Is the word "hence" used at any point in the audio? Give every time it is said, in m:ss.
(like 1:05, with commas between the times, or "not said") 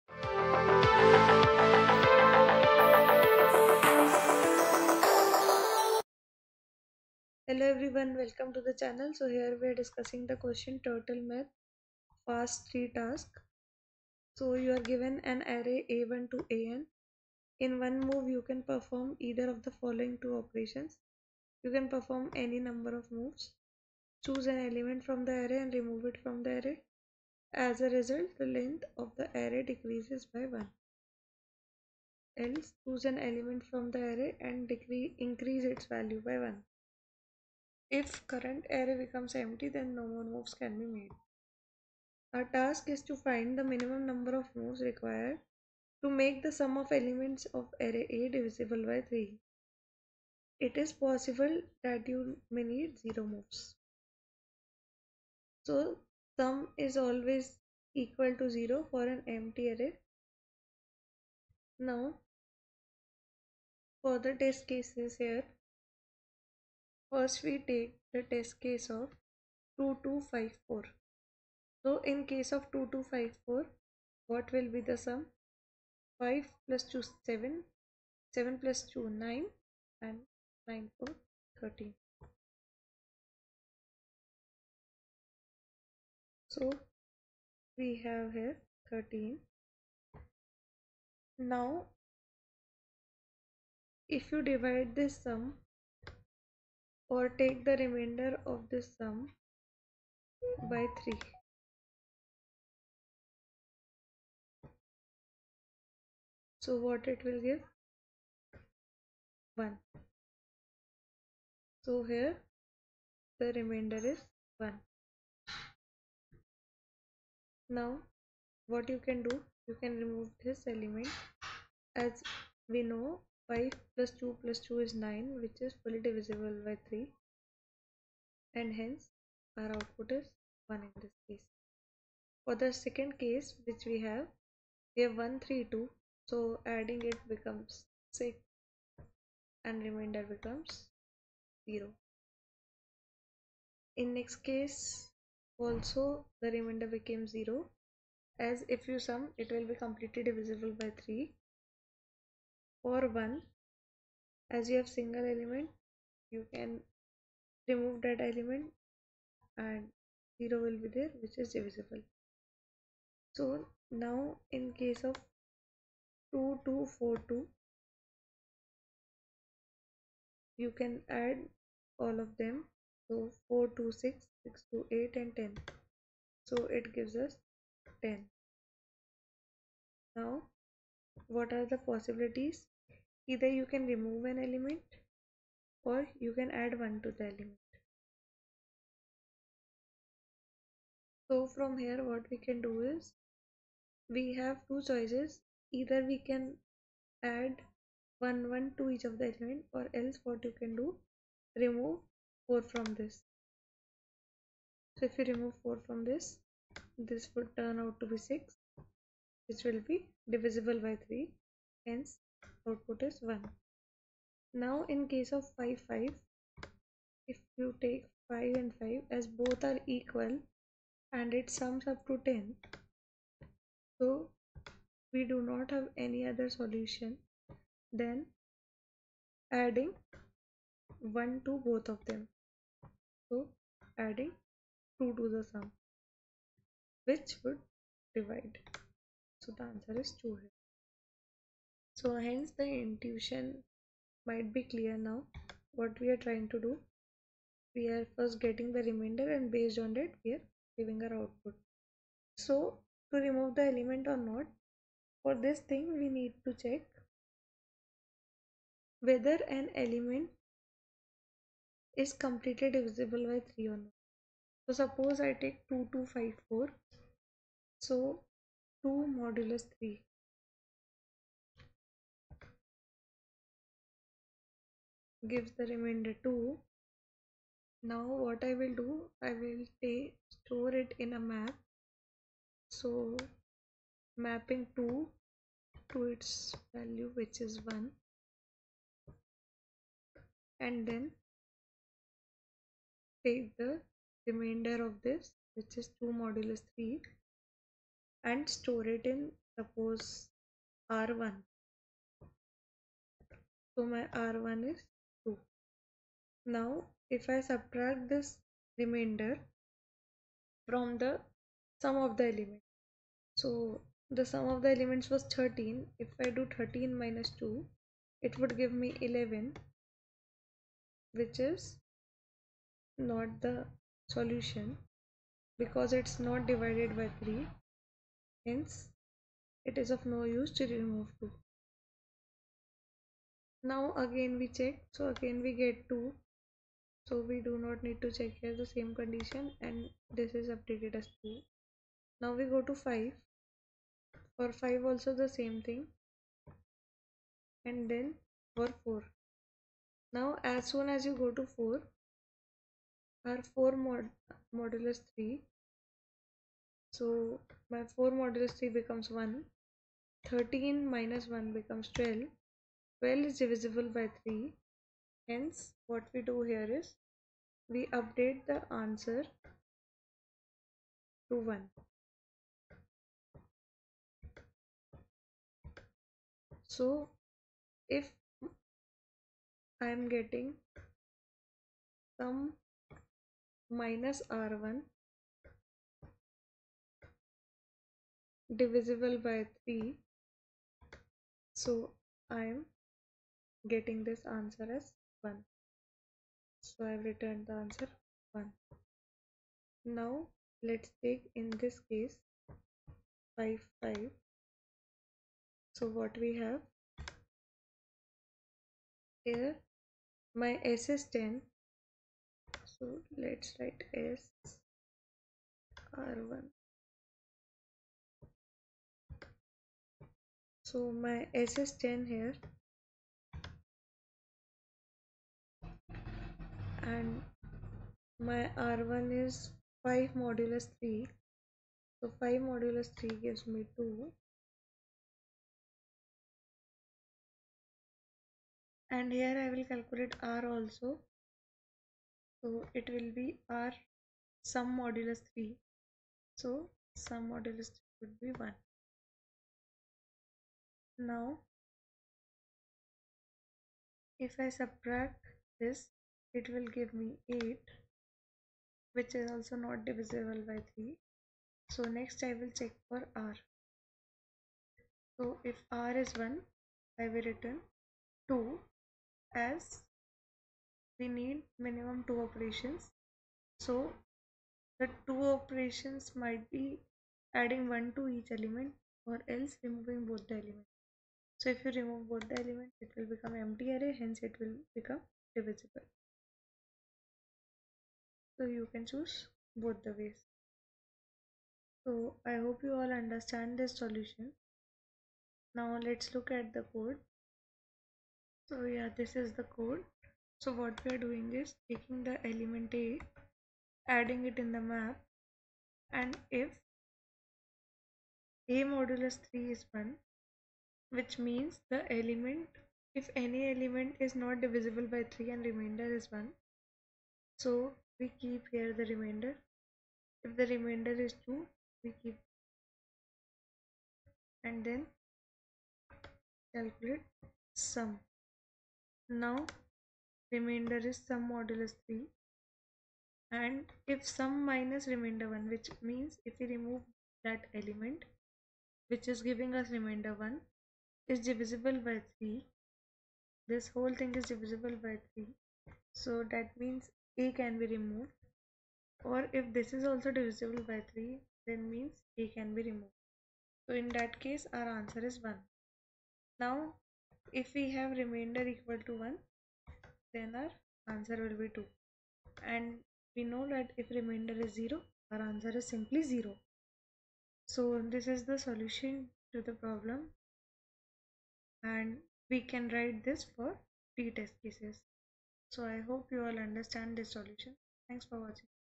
2:08, 3:31, 4:02, 5:28, 6:05, 8:03.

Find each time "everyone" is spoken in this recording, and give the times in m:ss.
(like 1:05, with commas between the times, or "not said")
0:07.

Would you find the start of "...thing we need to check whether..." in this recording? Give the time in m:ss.
4:15.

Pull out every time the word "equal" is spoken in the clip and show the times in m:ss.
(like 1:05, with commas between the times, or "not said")
0:57, 3:39, 9:18.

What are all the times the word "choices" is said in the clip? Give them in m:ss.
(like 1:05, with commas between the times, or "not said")
3:14.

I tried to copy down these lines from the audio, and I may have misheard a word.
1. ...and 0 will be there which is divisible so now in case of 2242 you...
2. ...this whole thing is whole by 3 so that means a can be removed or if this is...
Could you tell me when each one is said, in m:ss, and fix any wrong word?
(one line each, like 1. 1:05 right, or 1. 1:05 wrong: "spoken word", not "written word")
1. 2:39 right
2. 9:03 wrong: "divisible", not "whole".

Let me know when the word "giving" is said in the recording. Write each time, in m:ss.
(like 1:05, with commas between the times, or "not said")
4:10, 8:59.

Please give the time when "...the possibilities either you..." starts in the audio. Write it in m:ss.
3:01.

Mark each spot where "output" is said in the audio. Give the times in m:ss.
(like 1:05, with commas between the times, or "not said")
2:09, 3:32, 4:11.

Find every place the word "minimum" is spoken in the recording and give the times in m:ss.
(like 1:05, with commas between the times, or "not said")
0:43, 7:51.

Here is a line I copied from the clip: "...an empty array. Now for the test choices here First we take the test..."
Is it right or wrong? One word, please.
wrong.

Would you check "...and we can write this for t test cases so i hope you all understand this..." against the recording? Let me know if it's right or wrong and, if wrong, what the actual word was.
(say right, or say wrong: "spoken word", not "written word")
right.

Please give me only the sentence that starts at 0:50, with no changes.
It is possible that you may need 0 moves.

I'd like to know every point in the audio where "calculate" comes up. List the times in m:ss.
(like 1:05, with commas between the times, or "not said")
7:19, 8:46.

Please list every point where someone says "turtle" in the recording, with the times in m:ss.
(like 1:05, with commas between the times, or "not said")
0:10.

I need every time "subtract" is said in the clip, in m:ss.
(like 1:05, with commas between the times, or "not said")
5:07, 7:34.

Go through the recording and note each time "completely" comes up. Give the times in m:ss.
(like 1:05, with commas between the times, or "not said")
2:29, 4:22.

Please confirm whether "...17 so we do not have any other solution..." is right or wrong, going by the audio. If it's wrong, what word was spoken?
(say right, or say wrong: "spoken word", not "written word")
wrong: "10", not "17".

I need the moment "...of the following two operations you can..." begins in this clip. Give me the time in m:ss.
0:19.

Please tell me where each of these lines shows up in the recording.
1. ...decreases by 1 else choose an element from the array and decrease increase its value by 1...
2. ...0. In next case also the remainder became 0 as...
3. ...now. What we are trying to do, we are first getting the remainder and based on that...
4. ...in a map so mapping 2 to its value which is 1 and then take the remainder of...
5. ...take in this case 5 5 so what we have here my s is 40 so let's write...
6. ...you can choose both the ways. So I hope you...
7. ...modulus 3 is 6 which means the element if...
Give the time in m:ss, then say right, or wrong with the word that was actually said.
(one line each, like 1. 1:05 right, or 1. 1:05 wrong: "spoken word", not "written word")
1. 0:29 right
2. 2:21 right
3. 4:04 right
4. 4:40 right
5. 6:41 wrong: "10", not "40"
6. 8:08 right
7. 8:28 wrong: "1", not "6".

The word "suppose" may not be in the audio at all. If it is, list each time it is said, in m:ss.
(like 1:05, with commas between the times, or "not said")
4:24, 4:59.